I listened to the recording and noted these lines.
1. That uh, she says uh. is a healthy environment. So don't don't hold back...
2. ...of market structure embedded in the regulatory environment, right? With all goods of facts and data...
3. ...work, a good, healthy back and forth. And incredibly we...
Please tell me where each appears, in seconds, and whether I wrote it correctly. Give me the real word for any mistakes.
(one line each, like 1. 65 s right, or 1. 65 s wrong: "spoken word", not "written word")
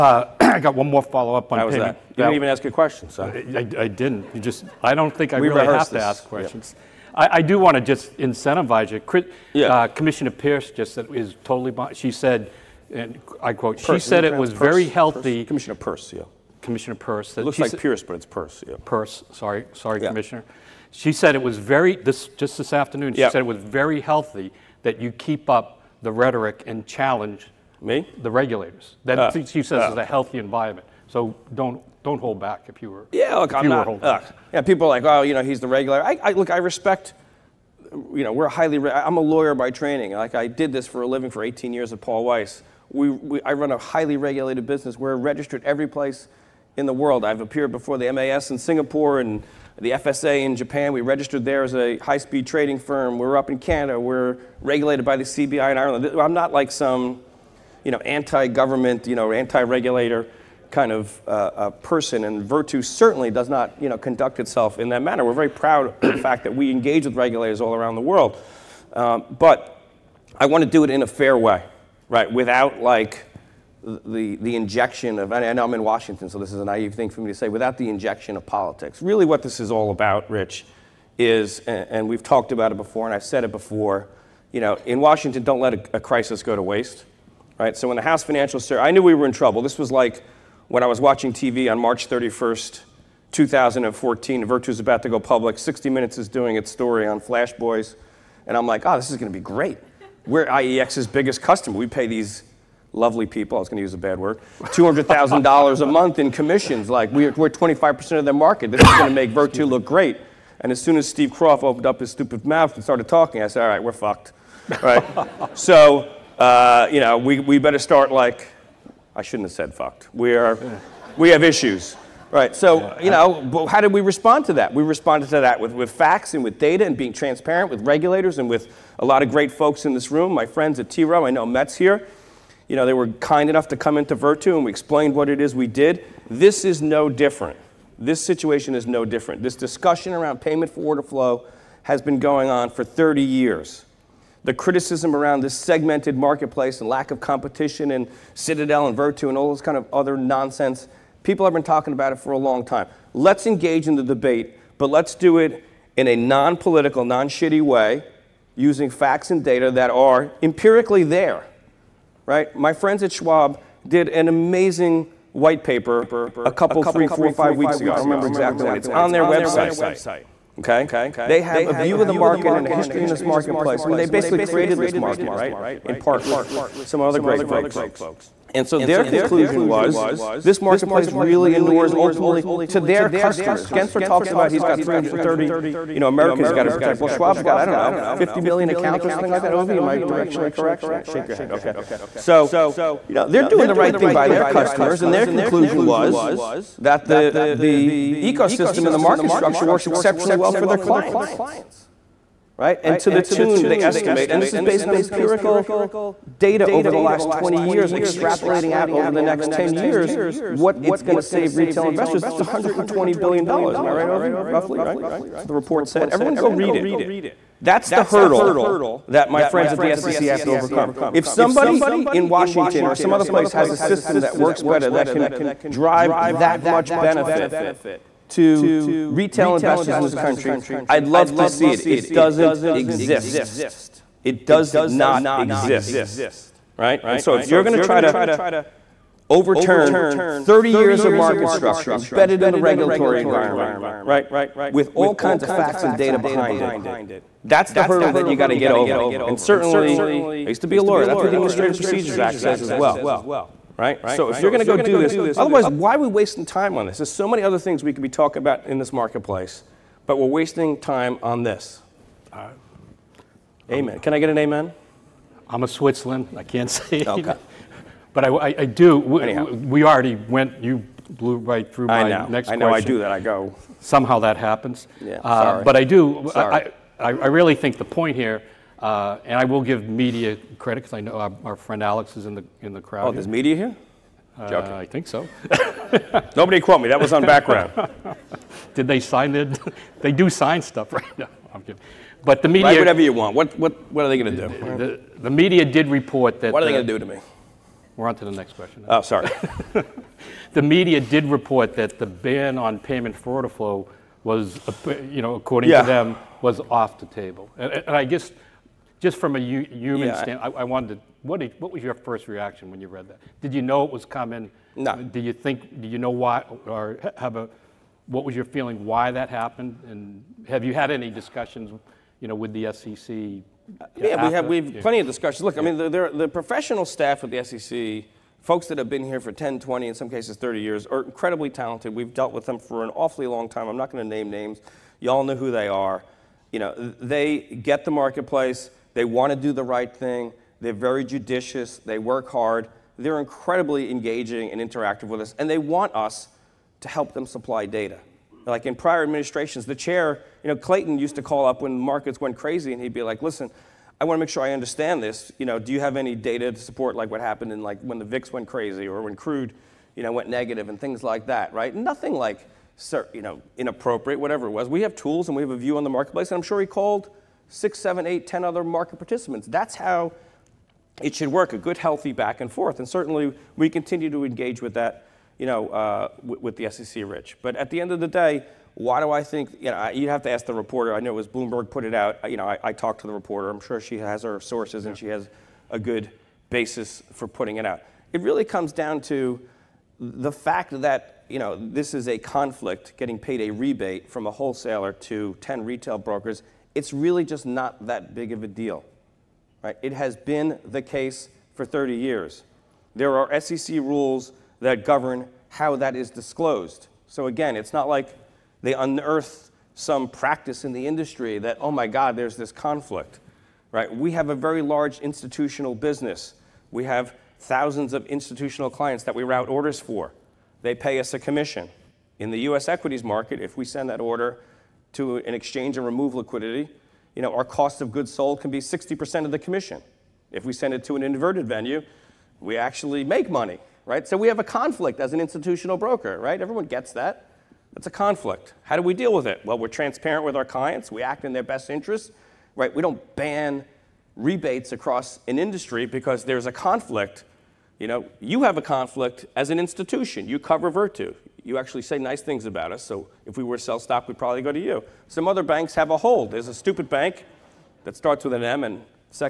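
1. 29 s right
2. 241 s wrong: "kinds", not "goods"
3. 371 s wrong: "certainly", not "incredibly".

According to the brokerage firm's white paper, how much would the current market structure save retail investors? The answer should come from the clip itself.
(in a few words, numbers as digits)
$120 billion.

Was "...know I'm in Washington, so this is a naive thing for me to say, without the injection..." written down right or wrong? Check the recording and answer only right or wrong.
right.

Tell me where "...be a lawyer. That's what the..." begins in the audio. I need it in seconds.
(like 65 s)
250 s.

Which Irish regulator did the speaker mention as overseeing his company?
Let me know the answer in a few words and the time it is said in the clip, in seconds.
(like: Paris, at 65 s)
CBI, at 55 s.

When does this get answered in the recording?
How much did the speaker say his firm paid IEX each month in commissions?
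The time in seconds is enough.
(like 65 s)
104 s.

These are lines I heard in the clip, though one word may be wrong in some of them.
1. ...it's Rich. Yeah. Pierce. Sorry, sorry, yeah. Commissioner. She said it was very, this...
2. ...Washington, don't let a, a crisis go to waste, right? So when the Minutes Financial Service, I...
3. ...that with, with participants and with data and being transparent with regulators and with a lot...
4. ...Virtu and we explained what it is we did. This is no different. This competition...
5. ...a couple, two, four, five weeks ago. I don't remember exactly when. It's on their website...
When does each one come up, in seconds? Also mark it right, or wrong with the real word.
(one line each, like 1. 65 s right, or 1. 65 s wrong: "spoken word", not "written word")
1. 18 s wrong: "Pierce", not "Rich"
2. 85 s wrong: "House", not "Minutes"
3. 125 s wrong: "facts", not "participants"
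4. 134 s wrong: "situation", not "competition"
5. 166 s wrong: "three", not "two".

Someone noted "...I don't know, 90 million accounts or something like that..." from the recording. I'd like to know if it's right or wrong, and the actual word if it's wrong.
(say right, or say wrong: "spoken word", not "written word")
wrong: "50", not "90".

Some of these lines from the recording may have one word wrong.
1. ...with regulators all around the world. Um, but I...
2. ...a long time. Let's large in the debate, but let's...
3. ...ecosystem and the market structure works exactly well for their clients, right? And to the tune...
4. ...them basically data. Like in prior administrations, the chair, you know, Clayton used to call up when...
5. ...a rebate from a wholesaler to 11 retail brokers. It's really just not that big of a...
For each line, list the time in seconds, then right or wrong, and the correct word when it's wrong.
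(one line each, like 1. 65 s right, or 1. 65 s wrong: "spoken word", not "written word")
1. 67 s right
2. 152 s wrong: "engage", not "large"
3. 198 s wrong: "exceptionally", not "exactly"
4. 347 s wrong: "supply", not "basically"
5. 393 s wrong: "10", not "11".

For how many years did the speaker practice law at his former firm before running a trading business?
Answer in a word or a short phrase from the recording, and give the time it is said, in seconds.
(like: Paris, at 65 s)
18 years, at 41 s.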